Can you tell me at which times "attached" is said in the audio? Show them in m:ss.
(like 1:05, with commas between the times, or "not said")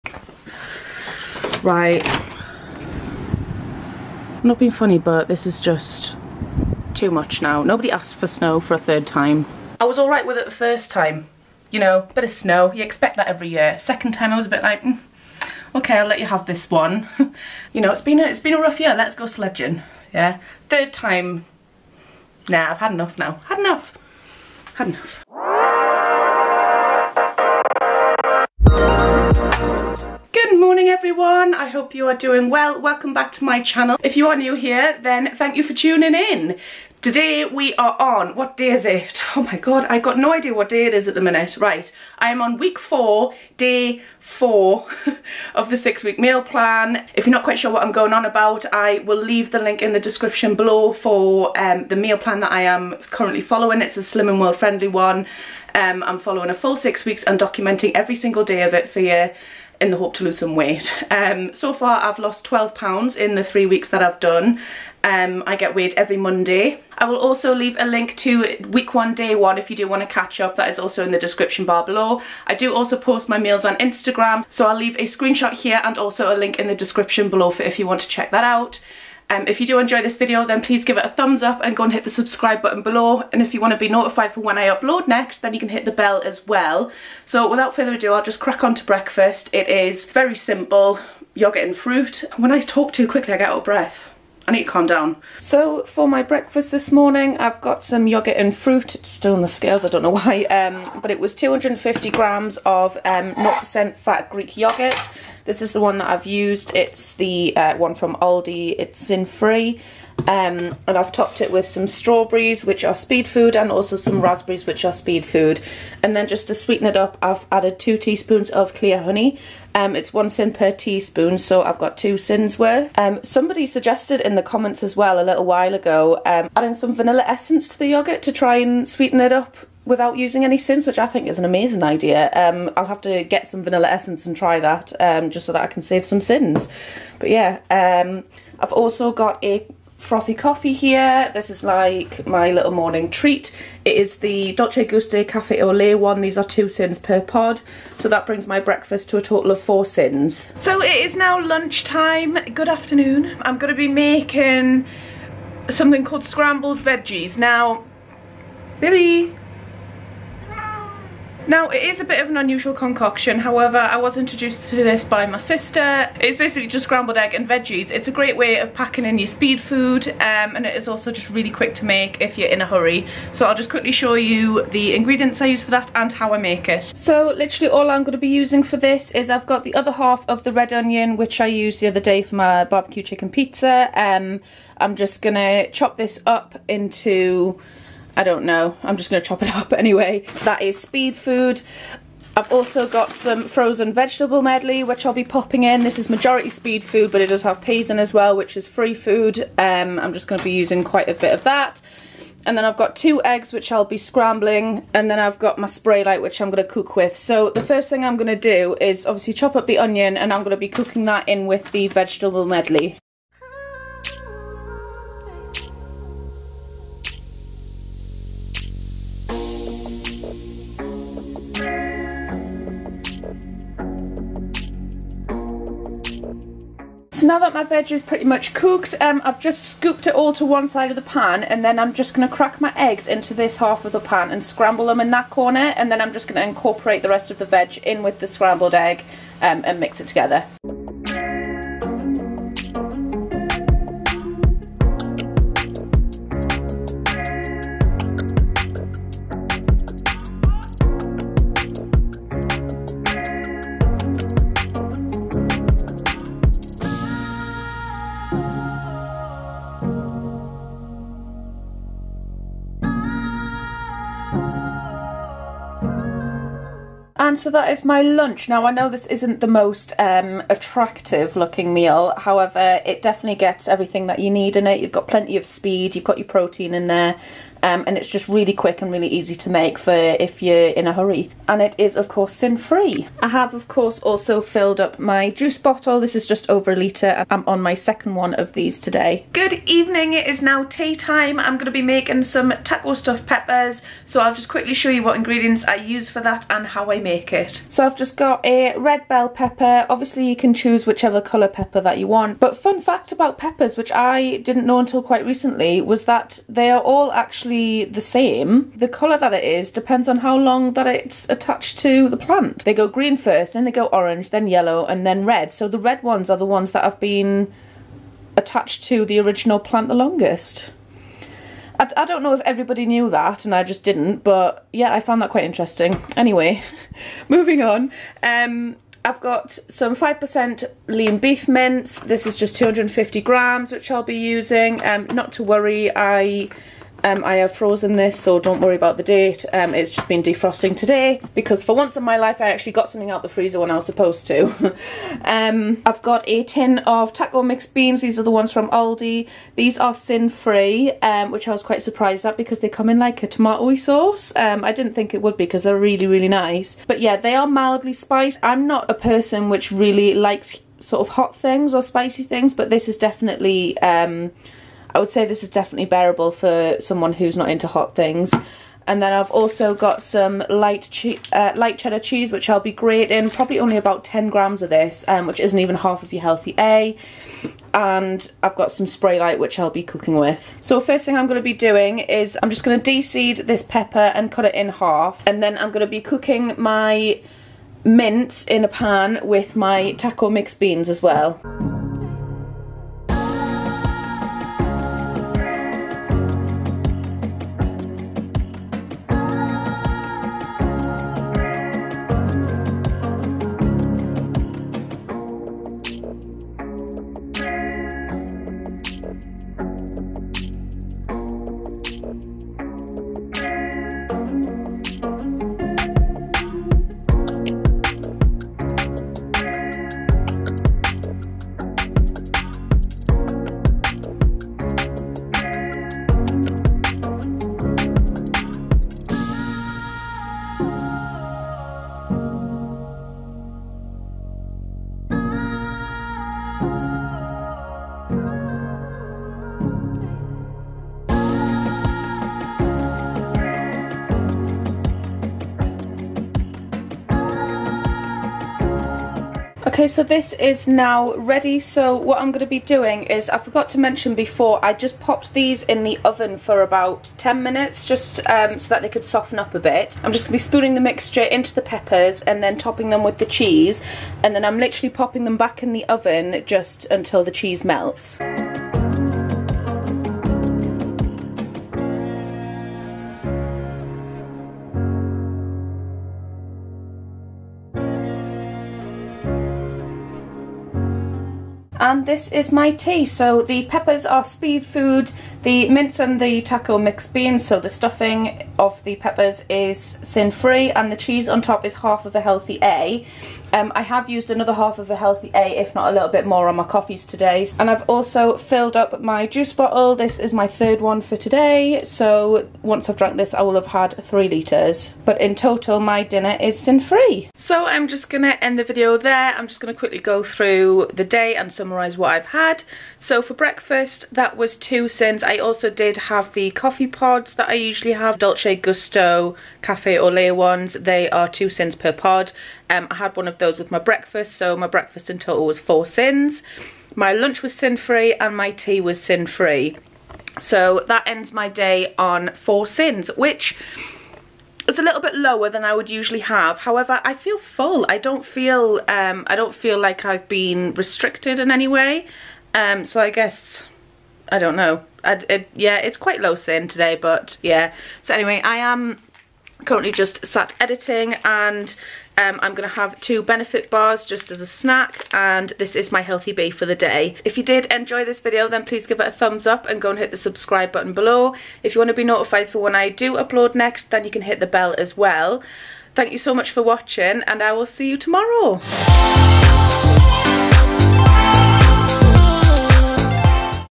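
5:11, 5:18.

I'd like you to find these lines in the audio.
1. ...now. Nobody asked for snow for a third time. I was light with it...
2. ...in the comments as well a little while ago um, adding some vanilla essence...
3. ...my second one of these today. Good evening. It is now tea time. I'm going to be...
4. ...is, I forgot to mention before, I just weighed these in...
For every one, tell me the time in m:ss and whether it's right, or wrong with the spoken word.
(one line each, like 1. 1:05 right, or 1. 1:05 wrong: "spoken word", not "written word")
1. 0:07 wrong: "alright", not "light"
2. 2:04 right
3. 4:47 right
4. 7:33 wrong: "popped", not "weighed".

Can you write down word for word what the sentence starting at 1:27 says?
So without further ado I'll just crack on to breakfast.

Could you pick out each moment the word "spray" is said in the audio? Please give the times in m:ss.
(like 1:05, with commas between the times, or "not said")
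3:25, 6:18.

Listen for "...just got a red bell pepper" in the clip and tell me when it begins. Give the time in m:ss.
4:57.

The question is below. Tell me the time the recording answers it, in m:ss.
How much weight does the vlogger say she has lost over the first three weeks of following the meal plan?
1:02.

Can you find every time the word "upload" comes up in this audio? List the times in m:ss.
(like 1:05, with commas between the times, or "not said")
1:24, 9:23.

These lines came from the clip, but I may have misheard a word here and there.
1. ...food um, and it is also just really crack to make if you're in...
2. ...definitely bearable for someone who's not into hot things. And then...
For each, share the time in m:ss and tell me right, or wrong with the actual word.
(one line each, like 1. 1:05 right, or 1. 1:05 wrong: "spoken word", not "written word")
1. 2:49 wrong: "quick", not "crack"
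2. 6:05 right.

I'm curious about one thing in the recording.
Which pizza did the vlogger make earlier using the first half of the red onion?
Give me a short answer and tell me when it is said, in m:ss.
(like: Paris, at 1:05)
barbecue chicken pizza, at 3:02.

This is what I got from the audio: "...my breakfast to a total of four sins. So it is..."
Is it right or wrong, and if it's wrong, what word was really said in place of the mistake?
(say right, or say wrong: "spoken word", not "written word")
right.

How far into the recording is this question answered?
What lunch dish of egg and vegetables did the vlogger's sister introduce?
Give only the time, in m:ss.
2:36.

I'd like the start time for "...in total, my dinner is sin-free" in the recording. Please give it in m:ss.
8:25.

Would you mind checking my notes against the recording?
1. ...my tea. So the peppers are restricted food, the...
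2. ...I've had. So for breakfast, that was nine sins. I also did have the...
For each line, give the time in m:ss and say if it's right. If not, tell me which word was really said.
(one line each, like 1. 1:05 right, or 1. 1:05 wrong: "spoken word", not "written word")
1. 8:02 wrong: "speed", not "restricted"
2. 8:32 wrong: "two", not "nine".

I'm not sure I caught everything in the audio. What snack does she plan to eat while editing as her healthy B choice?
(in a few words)
two benefit bars.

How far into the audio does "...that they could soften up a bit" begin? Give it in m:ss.
7:38.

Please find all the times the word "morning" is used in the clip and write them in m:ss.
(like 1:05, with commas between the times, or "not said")
0:30, 1:36, 2:22.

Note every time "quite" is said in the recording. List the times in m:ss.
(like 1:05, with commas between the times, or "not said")
0:47, 3:20, 5:05, 5:25, 5:51, 9:05.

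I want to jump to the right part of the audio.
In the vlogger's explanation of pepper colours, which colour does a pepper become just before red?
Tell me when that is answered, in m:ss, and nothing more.
5:14.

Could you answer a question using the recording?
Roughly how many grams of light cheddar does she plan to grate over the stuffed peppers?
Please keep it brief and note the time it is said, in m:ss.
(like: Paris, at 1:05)
10 grams, at 6:14.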